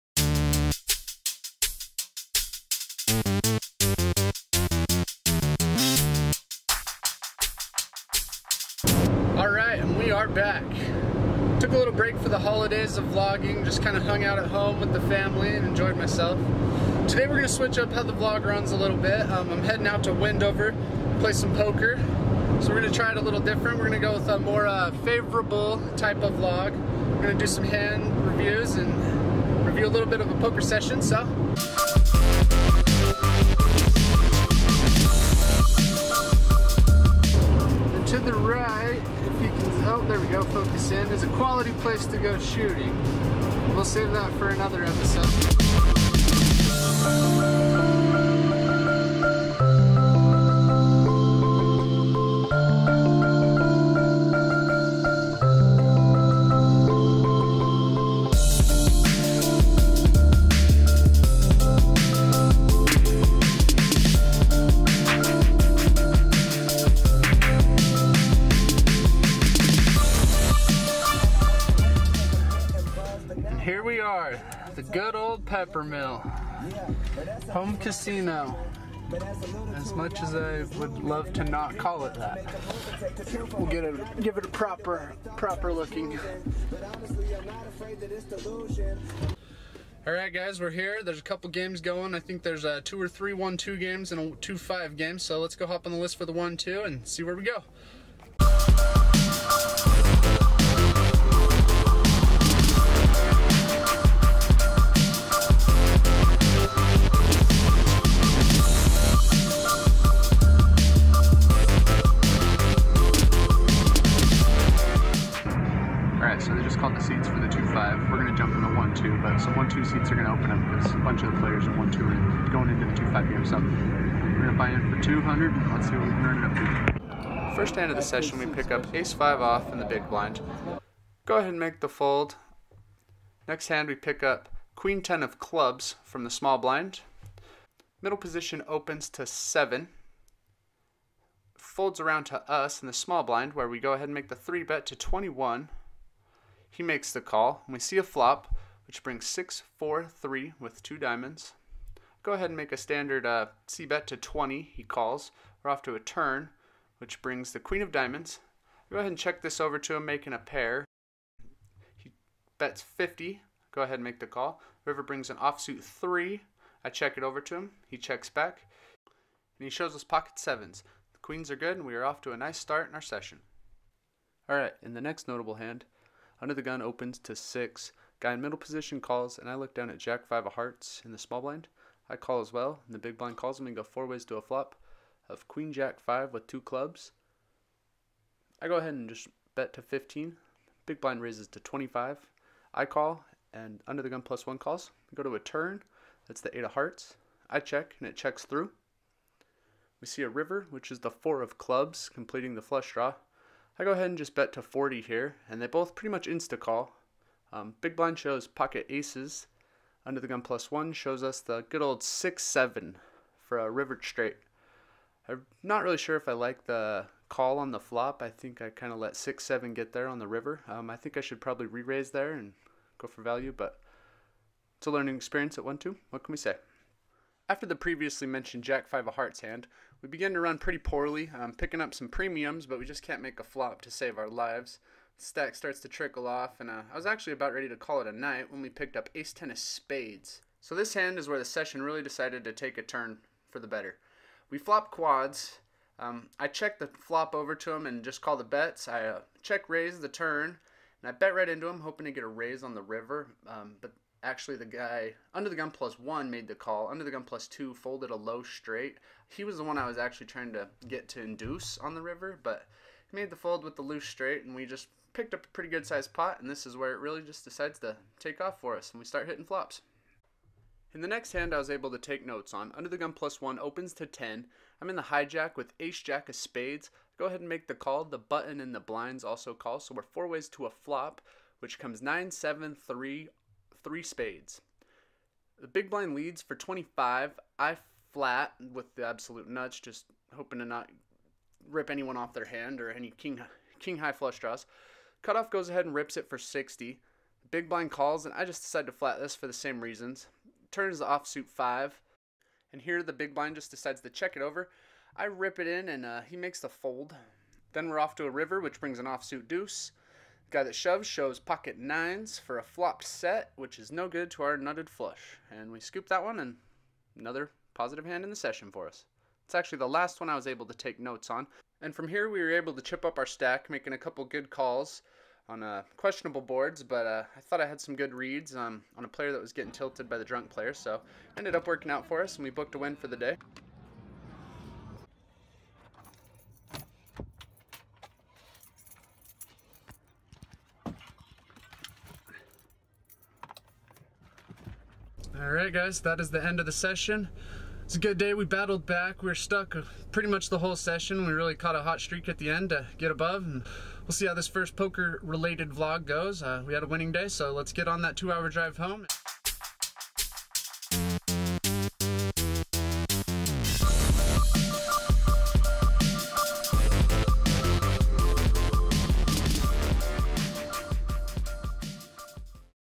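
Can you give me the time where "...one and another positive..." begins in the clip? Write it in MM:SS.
05:16.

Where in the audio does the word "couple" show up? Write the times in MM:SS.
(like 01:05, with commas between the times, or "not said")
01:31, 05:23.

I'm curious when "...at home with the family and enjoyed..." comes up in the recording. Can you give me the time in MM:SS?
00:14.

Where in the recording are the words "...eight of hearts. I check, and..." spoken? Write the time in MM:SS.
03:16.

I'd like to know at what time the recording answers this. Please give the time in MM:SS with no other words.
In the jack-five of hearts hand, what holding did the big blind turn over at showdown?
03:28.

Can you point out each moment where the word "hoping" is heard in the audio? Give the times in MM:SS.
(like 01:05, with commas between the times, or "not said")
04:11, 04:50.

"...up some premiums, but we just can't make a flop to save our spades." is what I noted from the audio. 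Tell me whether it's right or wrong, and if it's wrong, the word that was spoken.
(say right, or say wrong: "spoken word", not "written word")
wrong: "lives", not "spades".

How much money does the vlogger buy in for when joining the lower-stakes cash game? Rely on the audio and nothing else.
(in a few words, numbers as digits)
200.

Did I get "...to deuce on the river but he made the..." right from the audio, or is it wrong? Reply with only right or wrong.
wrong.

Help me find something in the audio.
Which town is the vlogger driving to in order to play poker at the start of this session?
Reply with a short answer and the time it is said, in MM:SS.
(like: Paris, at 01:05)
Wendover, at 00:20.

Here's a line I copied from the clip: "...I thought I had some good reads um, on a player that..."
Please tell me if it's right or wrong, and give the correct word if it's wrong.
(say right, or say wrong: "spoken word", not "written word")
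right.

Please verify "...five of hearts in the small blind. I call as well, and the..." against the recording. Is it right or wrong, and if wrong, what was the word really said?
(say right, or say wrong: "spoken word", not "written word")
right.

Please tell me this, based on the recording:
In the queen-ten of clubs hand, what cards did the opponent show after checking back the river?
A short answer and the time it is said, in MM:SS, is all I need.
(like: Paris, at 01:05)
pocket sevens, at 02:50.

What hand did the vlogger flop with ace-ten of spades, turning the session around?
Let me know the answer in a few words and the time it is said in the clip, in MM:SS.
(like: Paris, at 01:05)
quads, at 04:04.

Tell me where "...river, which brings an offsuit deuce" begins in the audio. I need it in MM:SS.
05:08.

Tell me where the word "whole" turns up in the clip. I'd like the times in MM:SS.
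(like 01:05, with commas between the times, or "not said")
05:50.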